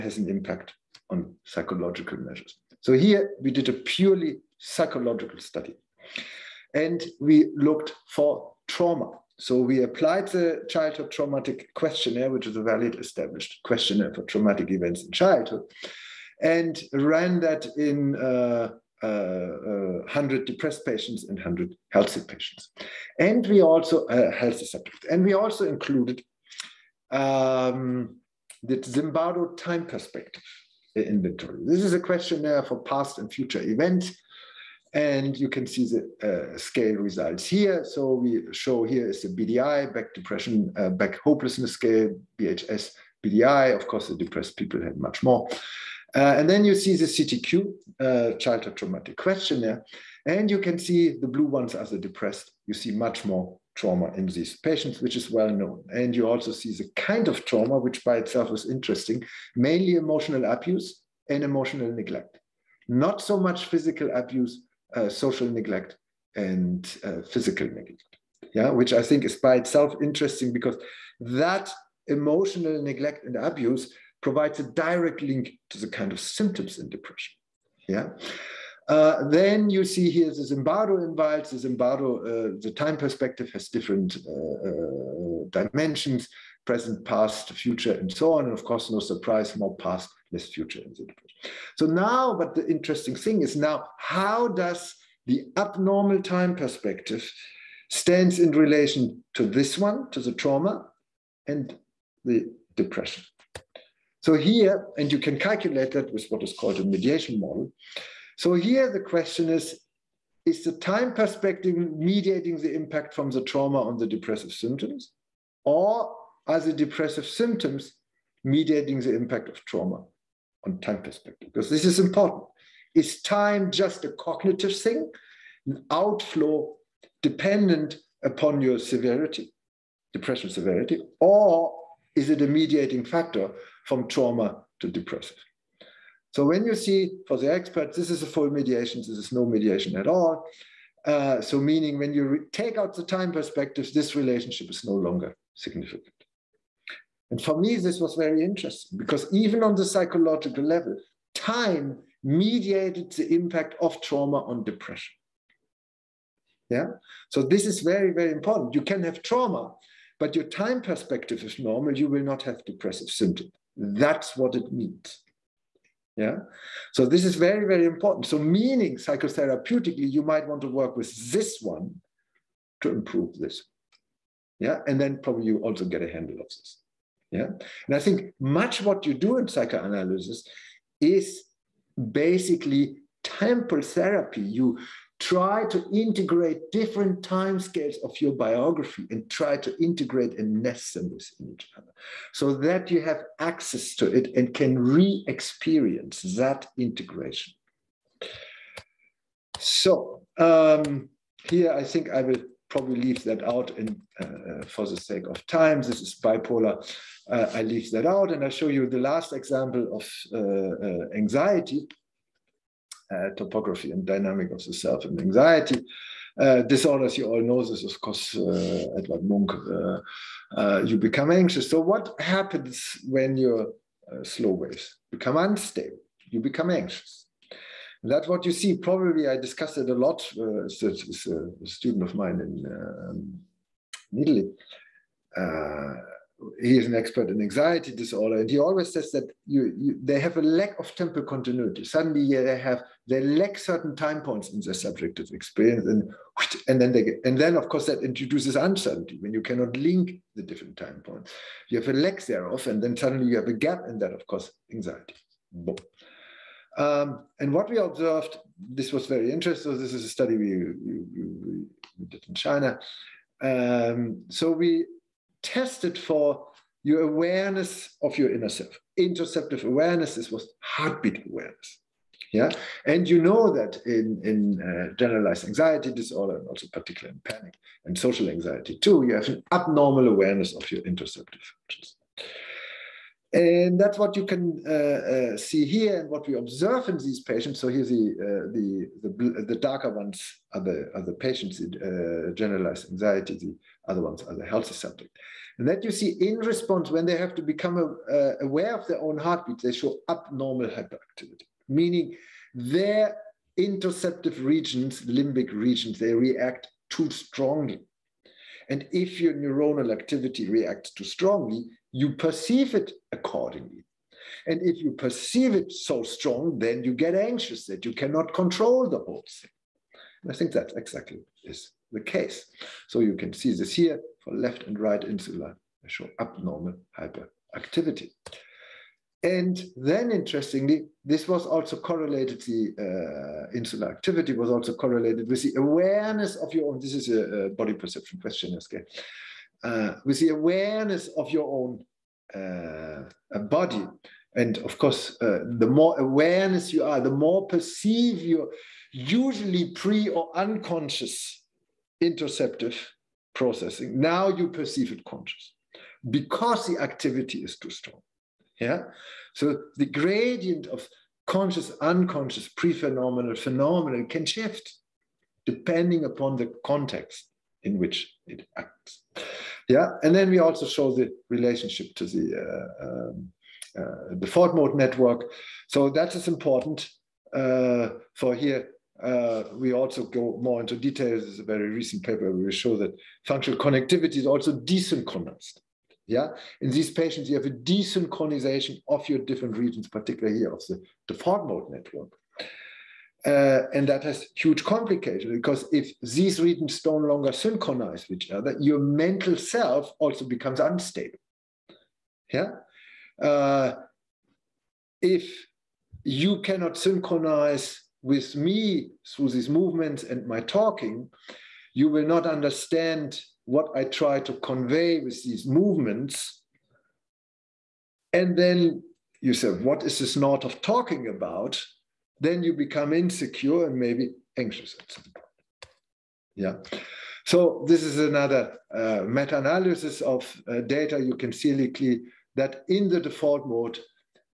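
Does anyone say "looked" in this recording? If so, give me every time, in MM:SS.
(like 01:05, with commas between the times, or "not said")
00:07.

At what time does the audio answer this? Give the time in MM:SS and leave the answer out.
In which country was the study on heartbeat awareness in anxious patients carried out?
04:22.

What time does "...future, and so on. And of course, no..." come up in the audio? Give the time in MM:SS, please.
01:27.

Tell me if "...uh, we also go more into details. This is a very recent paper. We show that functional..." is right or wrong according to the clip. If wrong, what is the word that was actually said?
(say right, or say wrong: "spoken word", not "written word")
right.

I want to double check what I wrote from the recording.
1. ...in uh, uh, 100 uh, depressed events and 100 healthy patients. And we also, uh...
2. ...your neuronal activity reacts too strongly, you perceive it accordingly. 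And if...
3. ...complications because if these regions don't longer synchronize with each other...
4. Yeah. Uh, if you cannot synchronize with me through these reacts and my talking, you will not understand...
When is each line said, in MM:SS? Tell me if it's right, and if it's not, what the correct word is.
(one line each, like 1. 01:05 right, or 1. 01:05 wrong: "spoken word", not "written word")
1. 00:17 wrong: "patients", not "events"
2. 05:09 right
3. 06:34 right
4. 06:42 wrong: "movements", not "reacts".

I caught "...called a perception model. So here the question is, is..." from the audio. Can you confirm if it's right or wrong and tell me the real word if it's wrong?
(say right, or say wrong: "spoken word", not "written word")
wrong: "mediation", not "perception".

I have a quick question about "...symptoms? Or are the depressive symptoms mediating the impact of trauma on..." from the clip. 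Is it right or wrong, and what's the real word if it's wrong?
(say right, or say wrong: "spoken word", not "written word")
right.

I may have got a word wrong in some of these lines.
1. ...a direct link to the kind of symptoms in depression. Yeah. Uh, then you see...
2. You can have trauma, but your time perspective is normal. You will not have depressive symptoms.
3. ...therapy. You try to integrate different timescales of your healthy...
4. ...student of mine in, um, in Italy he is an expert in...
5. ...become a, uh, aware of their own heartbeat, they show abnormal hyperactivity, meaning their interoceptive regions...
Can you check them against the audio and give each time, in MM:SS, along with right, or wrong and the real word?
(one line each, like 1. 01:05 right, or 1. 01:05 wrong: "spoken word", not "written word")
1. 01:14 right
2. 02:38 right
3. 03:03 wrong: "biography", not "healthy"
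4. 03:51 right
5. 04:57 right.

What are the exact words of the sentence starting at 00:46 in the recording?
Uh, and then you see the CTQ, uh, childhood traumatic questionnaire.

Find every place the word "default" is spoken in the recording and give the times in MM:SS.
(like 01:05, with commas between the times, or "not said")
06:14, 06:31, 07:13.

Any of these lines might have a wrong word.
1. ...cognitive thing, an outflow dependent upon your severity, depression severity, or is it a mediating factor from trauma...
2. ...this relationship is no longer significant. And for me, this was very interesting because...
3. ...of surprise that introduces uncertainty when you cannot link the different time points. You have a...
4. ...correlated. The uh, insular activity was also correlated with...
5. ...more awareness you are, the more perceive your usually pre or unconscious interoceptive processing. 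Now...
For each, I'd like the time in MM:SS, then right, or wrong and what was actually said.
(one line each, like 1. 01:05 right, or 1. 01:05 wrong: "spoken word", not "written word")
1. 02:04 right
2. 02:23 right
3. 04:07 wrong: "course", not "surprise"
4. 05:31 right
5. 05:45 right.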